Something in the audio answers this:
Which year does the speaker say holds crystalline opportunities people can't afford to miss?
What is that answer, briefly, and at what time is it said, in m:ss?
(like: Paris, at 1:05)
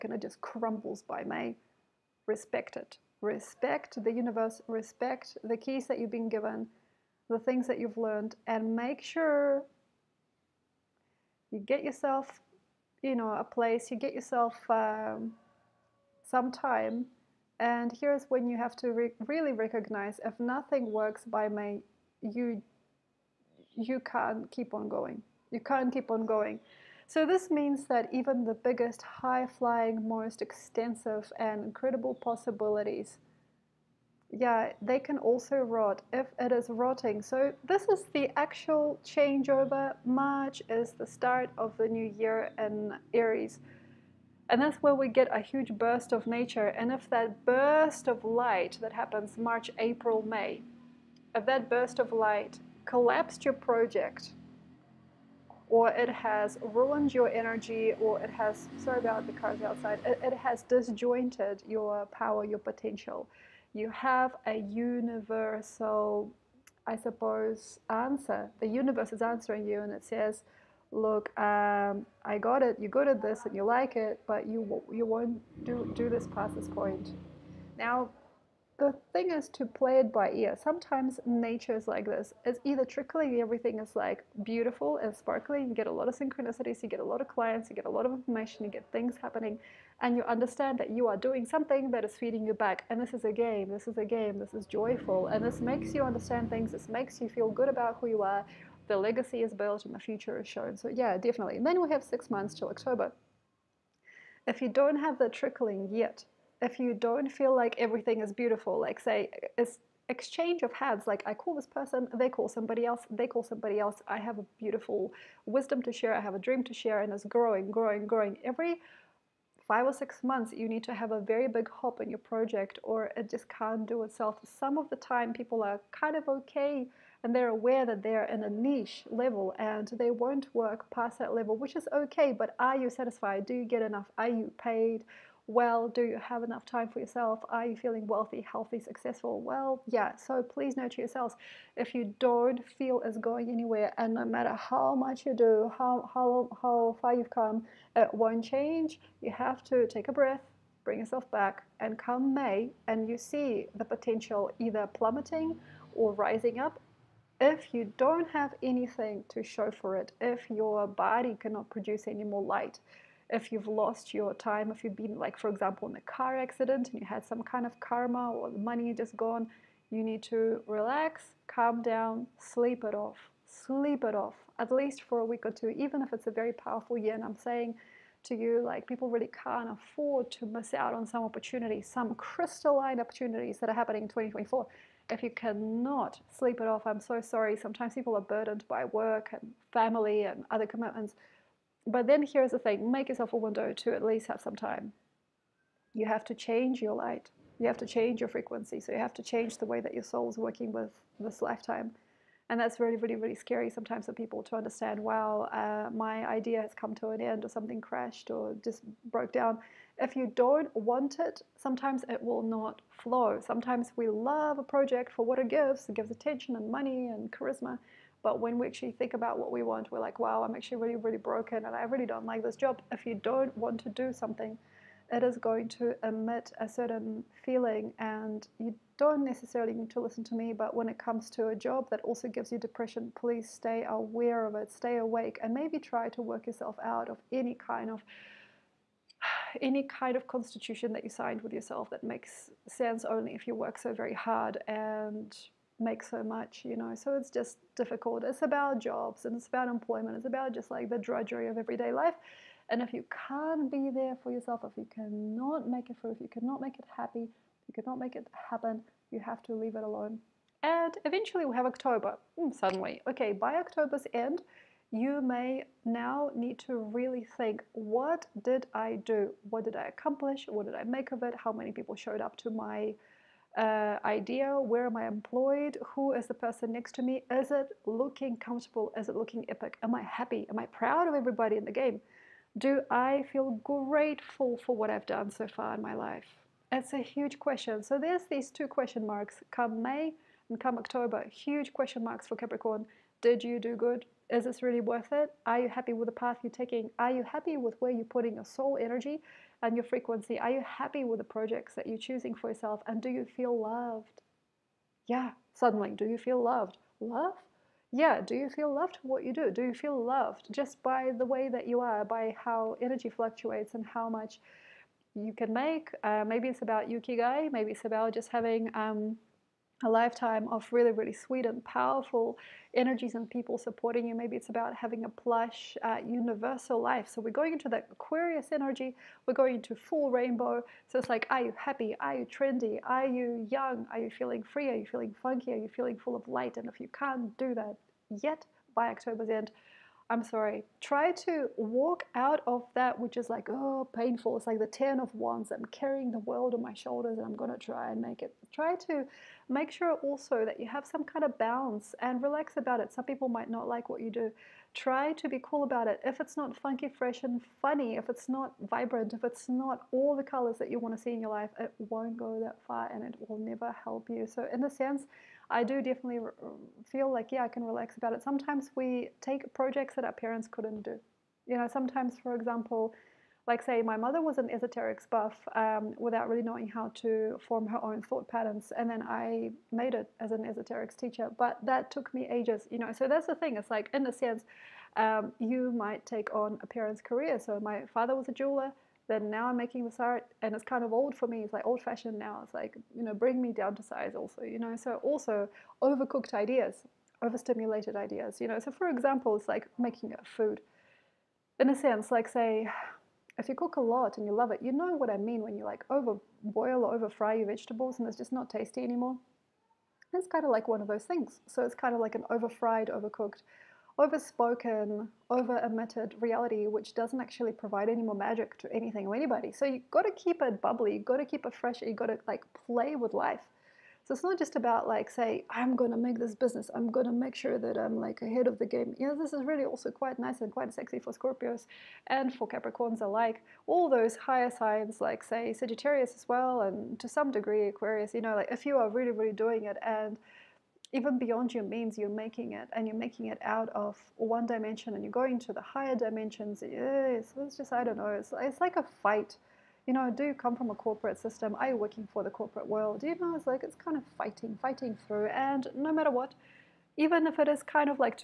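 2024, at 3:04.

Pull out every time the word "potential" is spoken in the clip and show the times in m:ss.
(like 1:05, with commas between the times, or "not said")
1:02, 2:33.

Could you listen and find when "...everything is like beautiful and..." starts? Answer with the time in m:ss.
1:23.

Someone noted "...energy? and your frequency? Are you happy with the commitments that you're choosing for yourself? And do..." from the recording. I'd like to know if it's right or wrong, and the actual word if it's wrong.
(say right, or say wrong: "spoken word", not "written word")
wrong: "projects", not "commitments".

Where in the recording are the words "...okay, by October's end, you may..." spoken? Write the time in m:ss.
4:23.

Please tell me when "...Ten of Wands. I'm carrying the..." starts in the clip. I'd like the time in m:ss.
5:44.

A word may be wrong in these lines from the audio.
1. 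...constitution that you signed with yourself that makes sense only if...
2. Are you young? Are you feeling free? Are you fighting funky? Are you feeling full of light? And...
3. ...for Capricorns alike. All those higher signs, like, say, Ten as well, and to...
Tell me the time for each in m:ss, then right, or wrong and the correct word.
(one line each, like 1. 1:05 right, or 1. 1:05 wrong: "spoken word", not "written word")
1. 4:00 right
2. 5:32 wrong: "feeling", not "fighting"
3. 7:12 wrong: "Sagittarius", not "Ten".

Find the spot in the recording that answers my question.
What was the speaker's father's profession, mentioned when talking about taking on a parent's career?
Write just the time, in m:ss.
6:28.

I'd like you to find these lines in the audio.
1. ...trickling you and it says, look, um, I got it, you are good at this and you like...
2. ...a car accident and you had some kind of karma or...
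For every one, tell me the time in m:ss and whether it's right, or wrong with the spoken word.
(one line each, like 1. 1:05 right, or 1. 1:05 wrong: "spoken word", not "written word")
1. 1:09 wrong: "answering", not "trickling"
2. 2:45 right.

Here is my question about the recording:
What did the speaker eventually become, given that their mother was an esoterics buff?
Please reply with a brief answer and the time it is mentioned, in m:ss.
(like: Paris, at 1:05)
esoterics teacher, at 6:20.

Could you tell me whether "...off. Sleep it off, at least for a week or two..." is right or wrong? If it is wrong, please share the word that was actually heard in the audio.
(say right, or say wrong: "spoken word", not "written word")
right.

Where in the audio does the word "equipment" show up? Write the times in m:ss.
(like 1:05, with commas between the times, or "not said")
not said.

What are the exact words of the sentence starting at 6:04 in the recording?
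So, in a sense, I do definitely feel like, yeah, I can relax about it.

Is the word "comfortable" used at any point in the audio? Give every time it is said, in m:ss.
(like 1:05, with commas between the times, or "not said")
4:38.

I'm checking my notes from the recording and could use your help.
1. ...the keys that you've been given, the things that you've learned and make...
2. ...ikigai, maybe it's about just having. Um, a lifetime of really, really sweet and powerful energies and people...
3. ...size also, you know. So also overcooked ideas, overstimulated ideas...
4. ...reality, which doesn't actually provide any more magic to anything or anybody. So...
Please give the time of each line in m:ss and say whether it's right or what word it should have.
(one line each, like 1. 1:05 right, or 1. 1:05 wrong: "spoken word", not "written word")
1. 0:05 right
2. 5:16 right
3. 6:33 right
4. 6:56 right.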